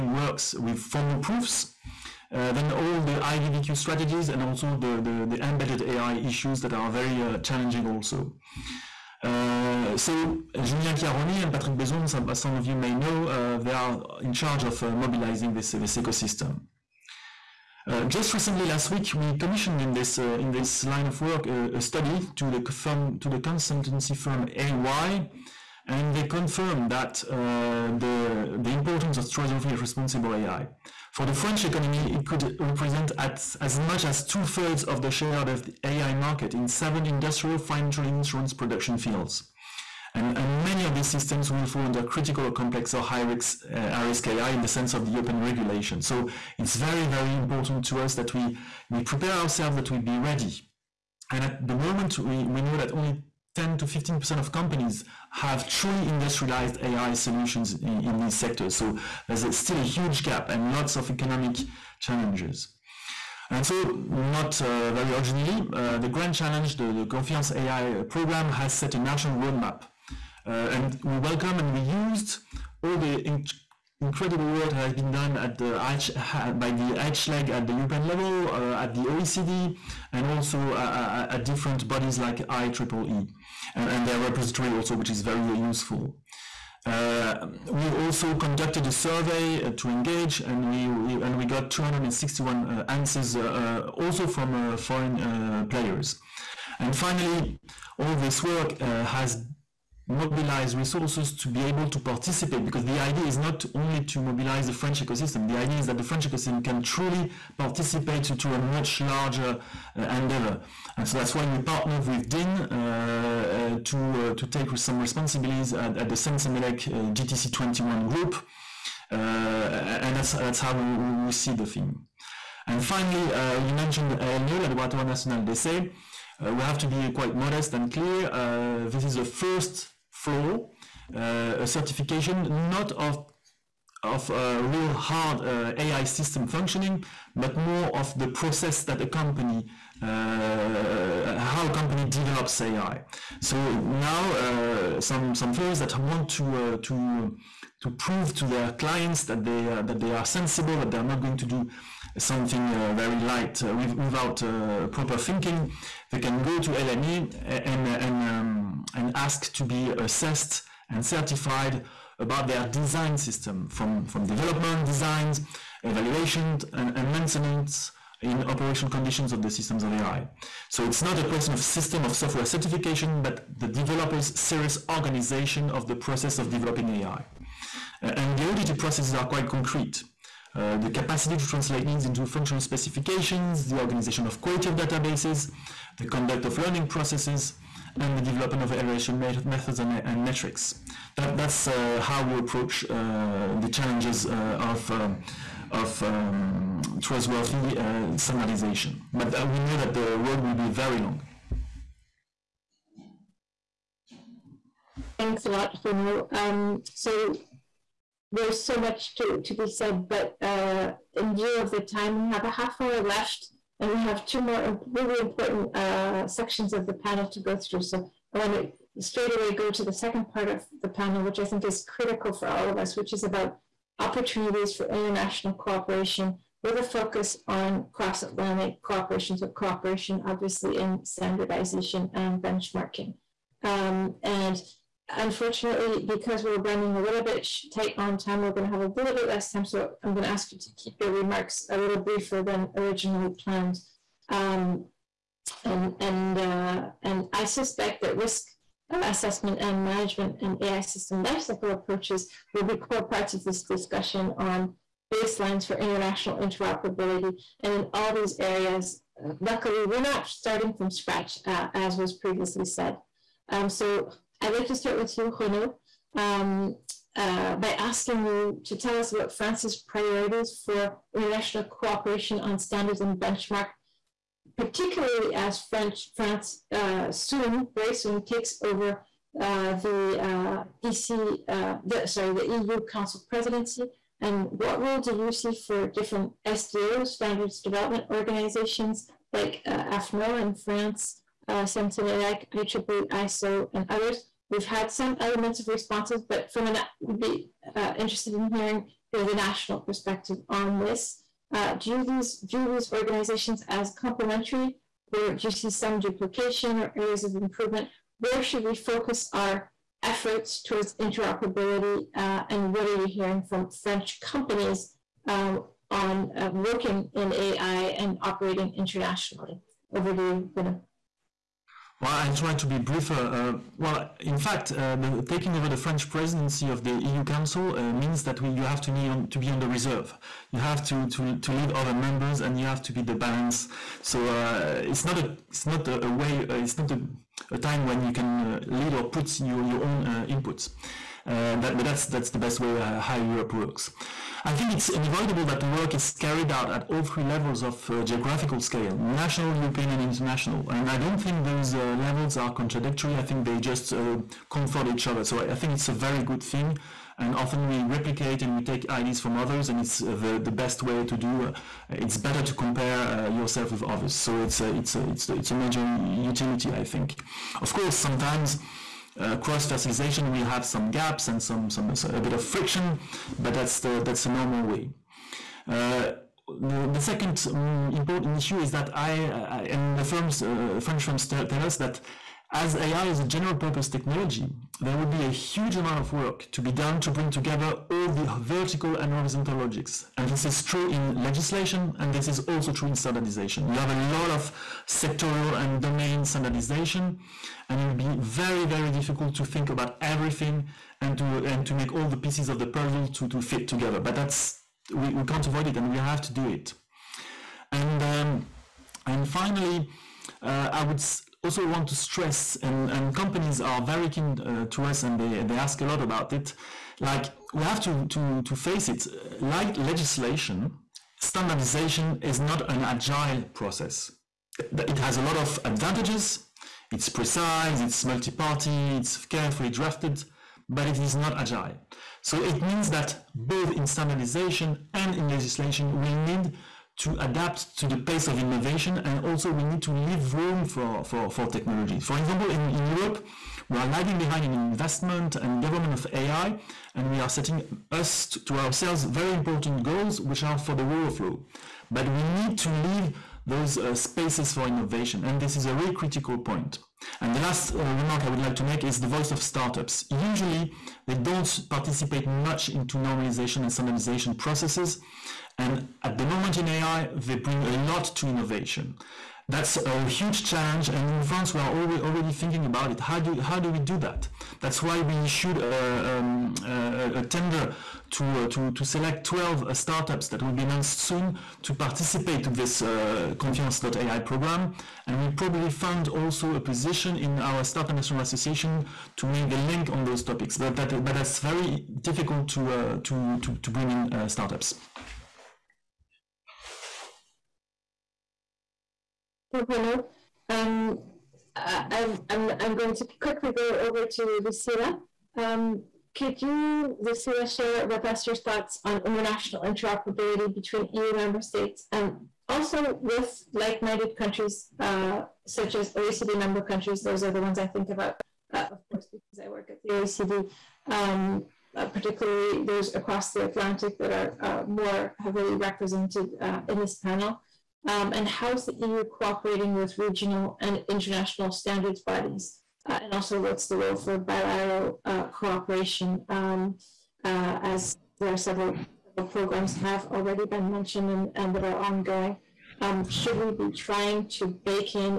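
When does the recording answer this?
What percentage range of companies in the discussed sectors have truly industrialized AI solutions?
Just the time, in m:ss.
0:53.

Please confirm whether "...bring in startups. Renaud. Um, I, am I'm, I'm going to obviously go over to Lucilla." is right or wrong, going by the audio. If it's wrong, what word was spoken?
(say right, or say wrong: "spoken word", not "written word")
wrong: "quickly", not "obviously".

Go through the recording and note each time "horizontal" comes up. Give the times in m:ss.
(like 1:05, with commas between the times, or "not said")
6:29.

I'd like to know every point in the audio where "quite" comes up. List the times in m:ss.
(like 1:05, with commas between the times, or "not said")
2:07, 2:59.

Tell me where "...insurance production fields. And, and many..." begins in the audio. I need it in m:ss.
0:38.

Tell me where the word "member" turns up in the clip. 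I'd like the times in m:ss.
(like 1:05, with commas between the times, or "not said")
5:31, 8:31, 8:36.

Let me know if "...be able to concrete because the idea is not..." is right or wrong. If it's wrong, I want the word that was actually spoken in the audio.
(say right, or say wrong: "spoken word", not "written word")
wrong: "participate", not "concrete".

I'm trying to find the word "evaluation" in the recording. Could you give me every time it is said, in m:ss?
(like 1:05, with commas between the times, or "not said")
2:45, 3:08.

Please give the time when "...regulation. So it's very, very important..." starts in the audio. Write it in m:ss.
0:45.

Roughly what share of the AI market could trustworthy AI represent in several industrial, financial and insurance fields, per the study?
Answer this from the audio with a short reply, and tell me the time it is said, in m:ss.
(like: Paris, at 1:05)
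two thirds, at 0:34.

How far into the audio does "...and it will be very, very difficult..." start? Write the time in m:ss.
6:37.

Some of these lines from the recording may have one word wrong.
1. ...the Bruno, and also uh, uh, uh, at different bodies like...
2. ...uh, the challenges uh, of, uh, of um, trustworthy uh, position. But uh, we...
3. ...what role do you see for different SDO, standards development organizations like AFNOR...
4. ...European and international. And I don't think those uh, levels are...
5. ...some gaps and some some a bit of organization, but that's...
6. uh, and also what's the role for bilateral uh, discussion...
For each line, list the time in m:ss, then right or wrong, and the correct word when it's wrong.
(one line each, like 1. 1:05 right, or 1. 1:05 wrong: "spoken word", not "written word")
1. 1:18 wrong: "OECD", not "Bruno"
2. 3:12 wrong: "standardization", not "position"
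3. 4:44 right
4. 5:49 right
5. 6:10 wrong: "friction", not "organization"
6. 8:52 wrong: "cooperation", not "discussion".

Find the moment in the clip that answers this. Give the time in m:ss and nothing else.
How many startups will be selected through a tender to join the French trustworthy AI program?
7:59.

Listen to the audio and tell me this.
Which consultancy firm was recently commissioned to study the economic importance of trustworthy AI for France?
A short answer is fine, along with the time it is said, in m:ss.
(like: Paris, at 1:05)
EY, at 0:24.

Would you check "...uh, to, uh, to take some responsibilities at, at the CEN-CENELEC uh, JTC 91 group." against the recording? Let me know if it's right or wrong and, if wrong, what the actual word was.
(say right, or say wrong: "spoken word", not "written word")
wrong: "21", not "91".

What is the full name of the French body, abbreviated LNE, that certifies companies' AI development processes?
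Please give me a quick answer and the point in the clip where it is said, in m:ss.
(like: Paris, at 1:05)
Laboratoire National d'Essai, at 2:04.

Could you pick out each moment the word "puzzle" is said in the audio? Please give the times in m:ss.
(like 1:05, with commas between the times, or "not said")
6:42.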